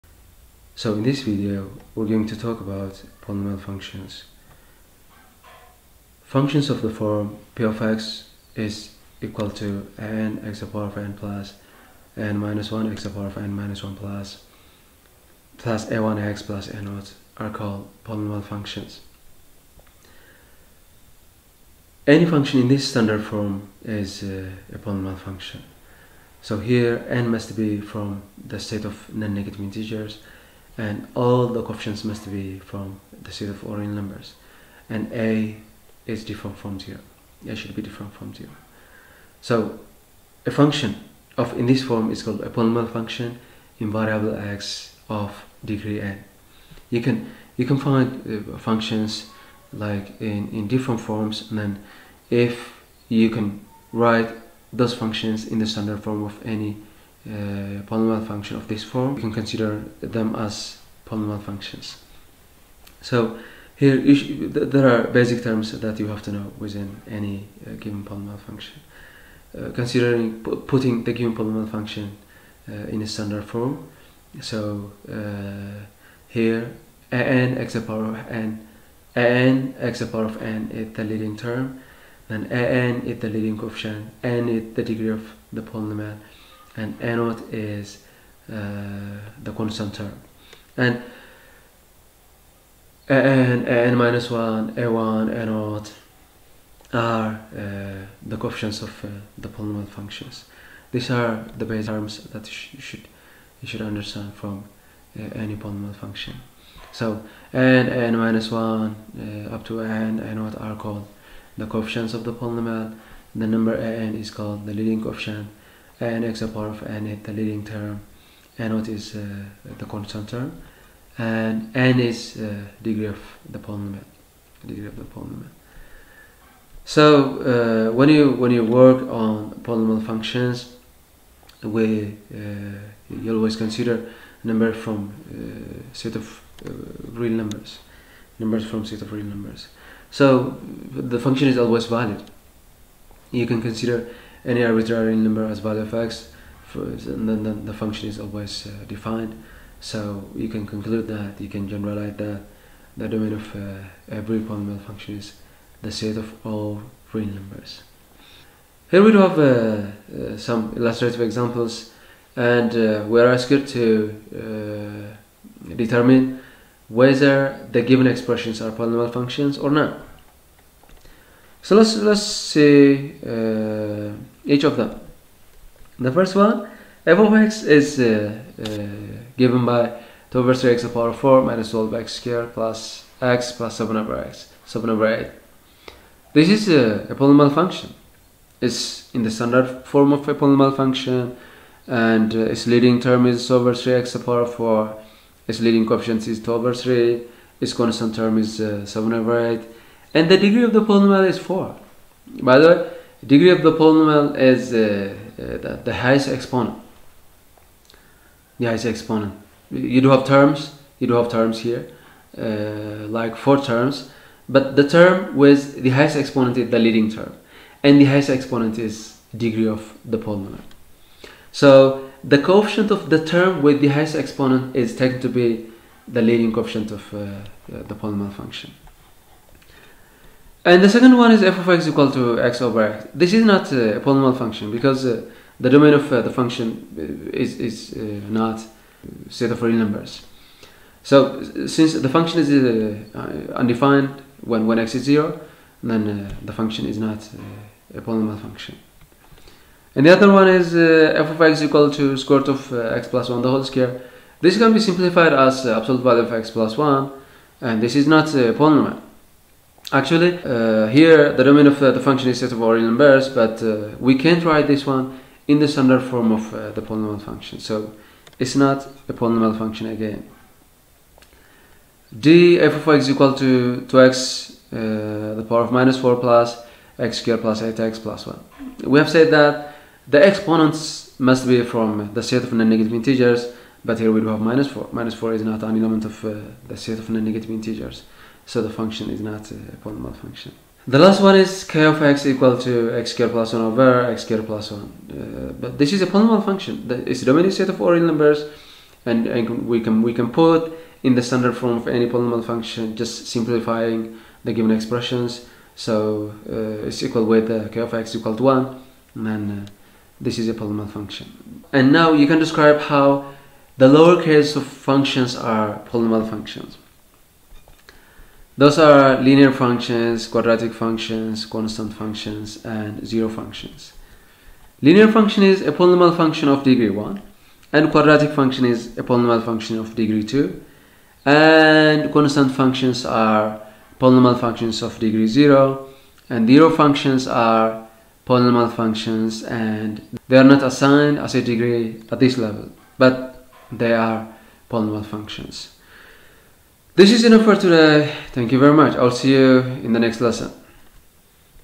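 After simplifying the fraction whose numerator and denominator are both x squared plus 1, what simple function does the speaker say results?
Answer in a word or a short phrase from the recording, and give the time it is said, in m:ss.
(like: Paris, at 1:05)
k(x) = 1, at 5:07.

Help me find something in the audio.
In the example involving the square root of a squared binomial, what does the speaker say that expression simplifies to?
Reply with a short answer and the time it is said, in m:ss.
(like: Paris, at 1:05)
absolute value of x plus 1, at 4:15.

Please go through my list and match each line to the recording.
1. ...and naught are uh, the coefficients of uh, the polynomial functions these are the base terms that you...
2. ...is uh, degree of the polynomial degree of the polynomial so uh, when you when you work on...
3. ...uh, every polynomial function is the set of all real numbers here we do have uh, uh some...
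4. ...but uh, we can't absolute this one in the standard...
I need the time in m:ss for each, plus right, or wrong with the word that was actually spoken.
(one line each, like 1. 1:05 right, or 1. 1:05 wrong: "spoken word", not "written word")
1. 1:35 right
2. 2:01 right
3. 2:33 right
4. 4:23 wrong: "write", not "absolute".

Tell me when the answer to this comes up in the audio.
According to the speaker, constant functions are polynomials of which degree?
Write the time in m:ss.
5:34.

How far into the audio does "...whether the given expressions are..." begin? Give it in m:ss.
2:46.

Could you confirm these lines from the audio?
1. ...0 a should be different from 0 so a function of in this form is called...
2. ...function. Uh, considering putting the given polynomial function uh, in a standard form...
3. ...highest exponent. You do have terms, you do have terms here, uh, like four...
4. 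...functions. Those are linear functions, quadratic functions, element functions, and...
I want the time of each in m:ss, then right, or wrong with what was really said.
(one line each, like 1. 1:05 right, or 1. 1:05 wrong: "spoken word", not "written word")
1. 0:36 right
2. 1:08 right
3. 3:28 right
4. 5:16 wrong: "constant", not "element".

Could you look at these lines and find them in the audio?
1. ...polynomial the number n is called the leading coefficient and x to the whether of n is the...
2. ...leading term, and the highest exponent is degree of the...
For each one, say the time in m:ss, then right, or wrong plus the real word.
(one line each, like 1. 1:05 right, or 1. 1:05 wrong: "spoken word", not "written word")
1. 1:52 wrong: "power", not "whether"
2. 3:36 right.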